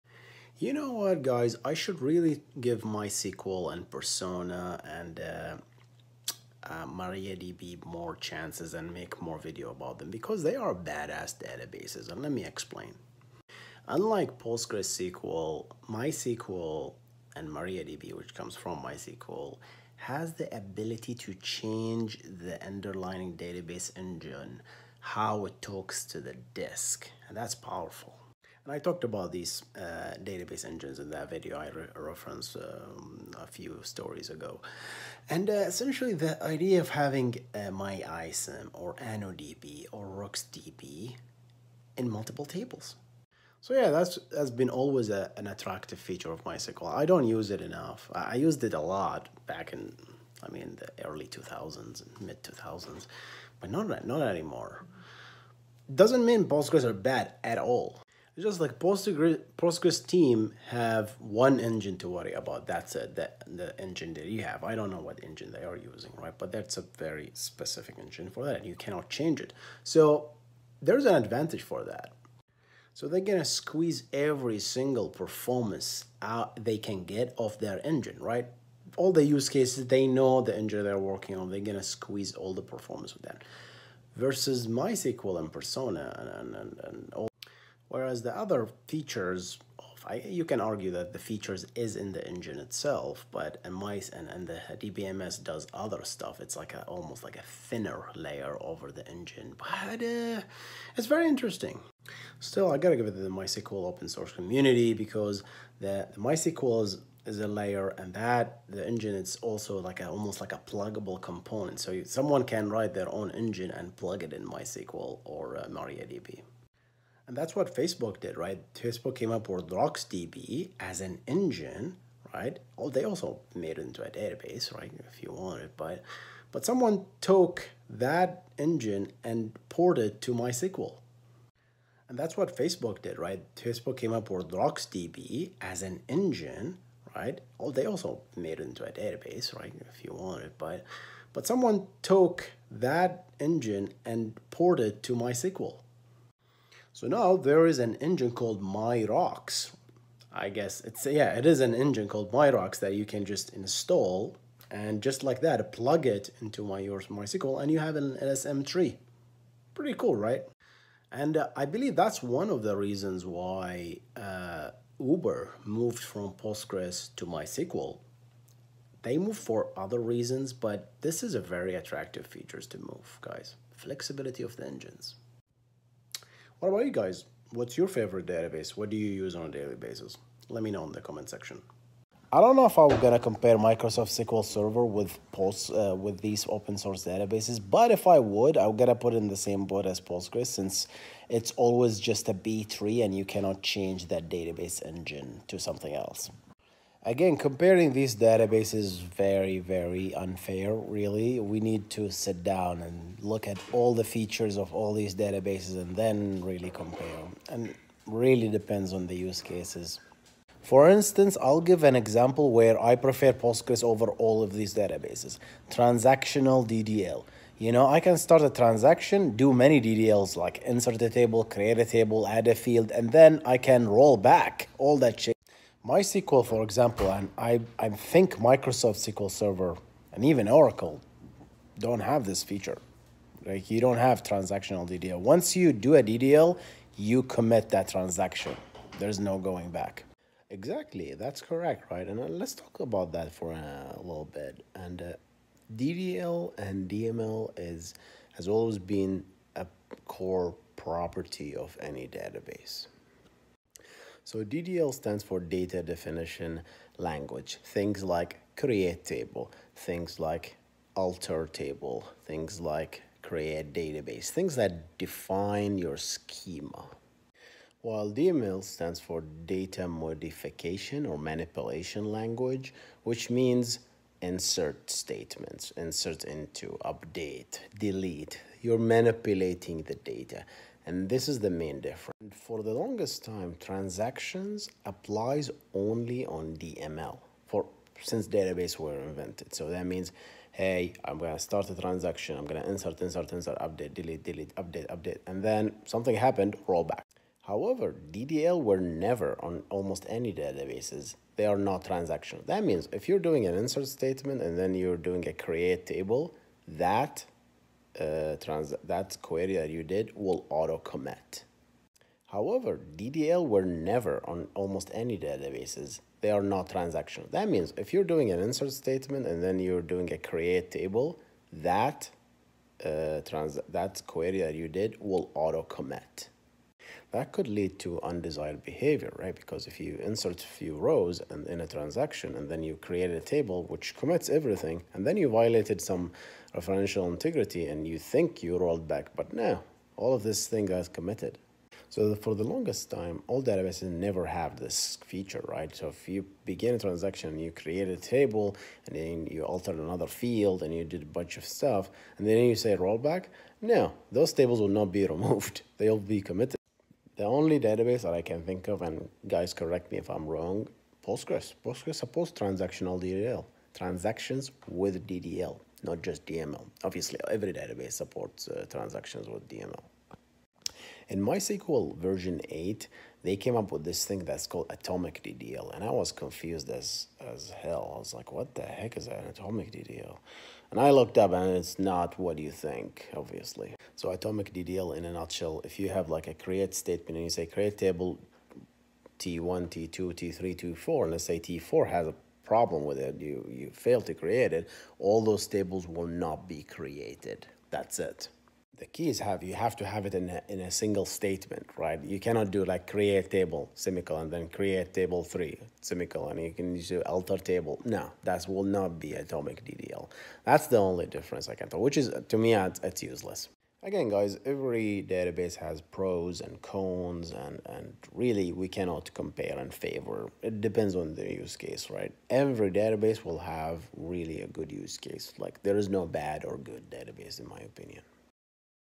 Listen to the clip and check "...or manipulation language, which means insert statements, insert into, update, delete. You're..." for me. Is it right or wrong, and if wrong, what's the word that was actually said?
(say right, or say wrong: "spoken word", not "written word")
right.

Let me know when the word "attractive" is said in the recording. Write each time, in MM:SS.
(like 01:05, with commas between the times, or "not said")
00:45, 02:51.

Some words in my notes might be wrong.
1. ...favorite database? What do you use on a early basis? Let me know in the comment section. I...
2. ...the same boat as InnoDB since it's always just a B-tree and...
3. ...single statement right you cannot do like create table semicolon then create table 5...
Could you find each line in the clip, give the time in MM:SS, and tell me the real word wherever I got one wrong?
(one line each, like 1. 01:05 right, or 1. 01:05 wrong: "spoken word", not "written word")
1. 02:57 wrong: "daily", not "early"
2. 03:09 wrong: "Postgres", not "InnoDB"
3. 06:40 wrong: "3", not "5".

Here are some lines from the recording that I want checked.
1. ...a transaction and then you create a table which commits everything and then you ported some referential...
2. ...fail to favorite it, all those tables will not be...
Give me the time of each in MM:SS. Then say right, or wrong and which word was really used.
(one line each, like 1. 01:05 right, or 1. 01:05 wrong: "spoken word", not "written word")
1. 05:31 wrong: "violated", not "ported"
2. 06:33 wrong: "create", not "favorite".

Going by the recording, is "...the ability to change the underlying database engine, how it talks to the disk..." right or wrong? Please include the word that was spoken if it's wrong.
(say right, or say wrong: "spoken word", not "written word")
right.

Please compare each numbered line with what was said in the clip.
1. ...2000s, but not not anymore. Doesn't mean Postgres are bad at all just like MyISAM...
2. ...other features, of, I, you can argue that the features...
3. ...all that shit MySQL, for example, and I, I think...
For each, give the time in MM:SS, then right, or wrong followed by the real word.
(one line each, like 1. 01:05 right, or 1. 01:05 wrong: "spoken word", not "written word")
1. 00:52 wrong: "Postgres", not "MyISAM"
2. 01:28 right
3. 03:44 right.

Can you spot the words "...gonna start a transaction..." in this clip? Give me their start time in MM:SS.
04:51.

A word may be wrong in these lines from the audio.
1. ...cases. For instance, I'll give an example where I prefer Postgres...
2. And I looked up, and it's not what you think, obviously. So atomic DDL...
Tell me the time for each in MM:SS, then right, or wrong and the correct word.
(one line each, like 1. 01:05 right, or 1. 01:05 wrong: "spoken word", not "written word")
1. 03:29 right
2. 06:20 right.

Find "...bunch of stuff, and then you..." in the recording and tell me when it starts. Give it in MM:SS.
05:51.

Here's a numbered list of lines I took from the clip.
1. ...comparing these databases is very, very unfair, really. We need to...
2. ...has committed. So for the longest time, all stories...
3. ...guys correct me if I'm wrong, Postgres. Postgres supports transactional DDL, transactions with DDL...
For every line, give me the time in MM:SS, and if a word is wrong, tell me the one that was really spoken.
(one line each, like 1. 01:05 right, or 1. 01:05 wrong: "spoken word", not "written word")
1. 03:17 right
2. 05:40 wrong: "databases", not "stories"
3. 05:59 right.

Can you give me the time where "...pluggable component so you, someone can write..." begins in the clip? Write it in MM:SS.
01:50.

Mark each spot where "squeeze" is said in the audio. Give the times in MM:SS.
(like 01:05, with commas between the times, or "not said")
01:13, 01:21.